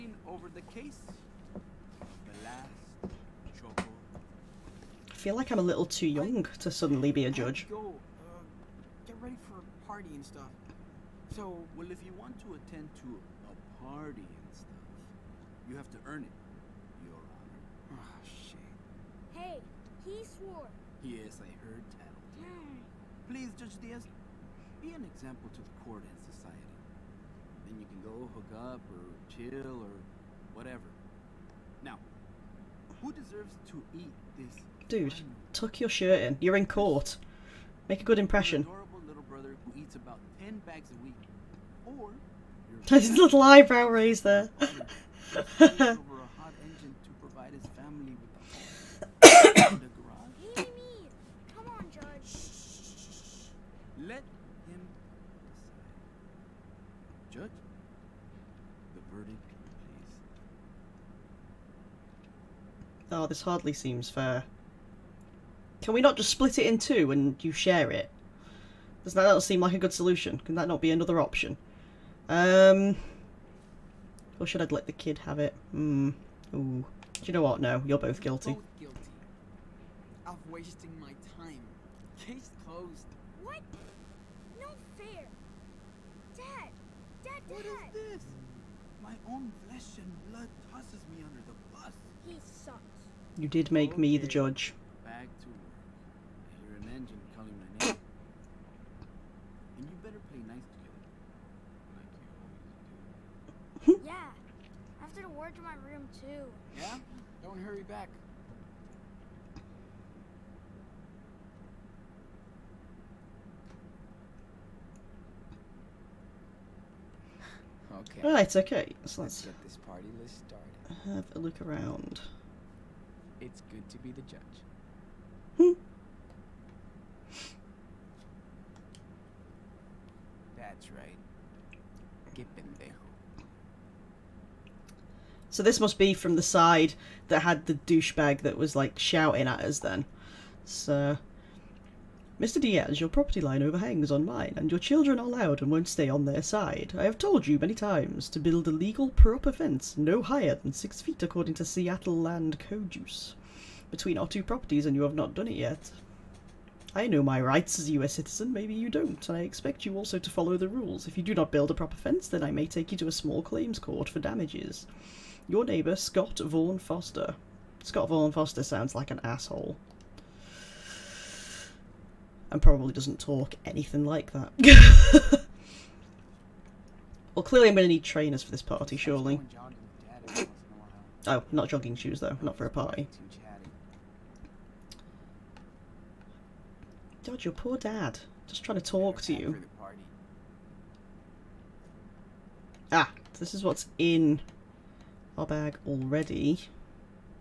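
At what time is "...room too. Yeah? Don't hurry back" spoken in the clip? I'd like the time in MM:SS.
01:45.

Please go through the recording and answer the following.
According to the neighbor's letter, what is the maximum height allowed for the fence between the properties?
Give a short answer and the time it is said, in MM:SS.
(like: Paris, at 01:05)
6 feet, at 02:30.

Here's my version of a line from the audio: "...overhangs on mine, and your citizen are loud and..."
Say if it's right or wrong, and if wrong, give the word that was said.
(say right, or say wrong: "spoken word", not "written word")
wrong: "children", not "citizen".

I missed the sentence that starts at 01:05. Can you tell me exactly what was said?
Can we not just split it in two and you share it?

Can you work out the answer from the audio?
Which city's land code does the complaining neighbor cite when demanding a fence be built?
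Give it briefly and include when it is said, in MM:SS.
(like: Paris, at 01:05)
Seattle, at 02:31.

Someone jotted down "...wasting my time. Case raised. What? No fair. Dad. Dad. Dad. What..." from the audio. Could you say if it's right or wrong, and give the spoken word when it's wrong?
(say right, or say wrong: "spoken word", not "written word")
wrong: "closed", not "raised".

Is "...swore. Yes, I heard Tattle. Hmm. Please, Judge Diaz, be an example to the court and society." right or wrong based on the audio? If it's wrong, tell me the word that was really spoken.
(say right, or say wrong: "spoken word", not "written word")
right.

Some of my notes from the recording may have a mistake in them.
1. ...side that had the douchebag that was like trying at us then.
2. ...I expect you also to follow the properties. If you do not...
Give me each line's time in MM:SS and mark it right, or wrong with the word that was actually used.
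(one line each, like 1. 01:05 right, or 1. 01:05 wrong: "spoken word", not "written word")
1. 02:16 wrong: "shouting", not "trying"
2. 02:39 wrong: "rules", not "properties".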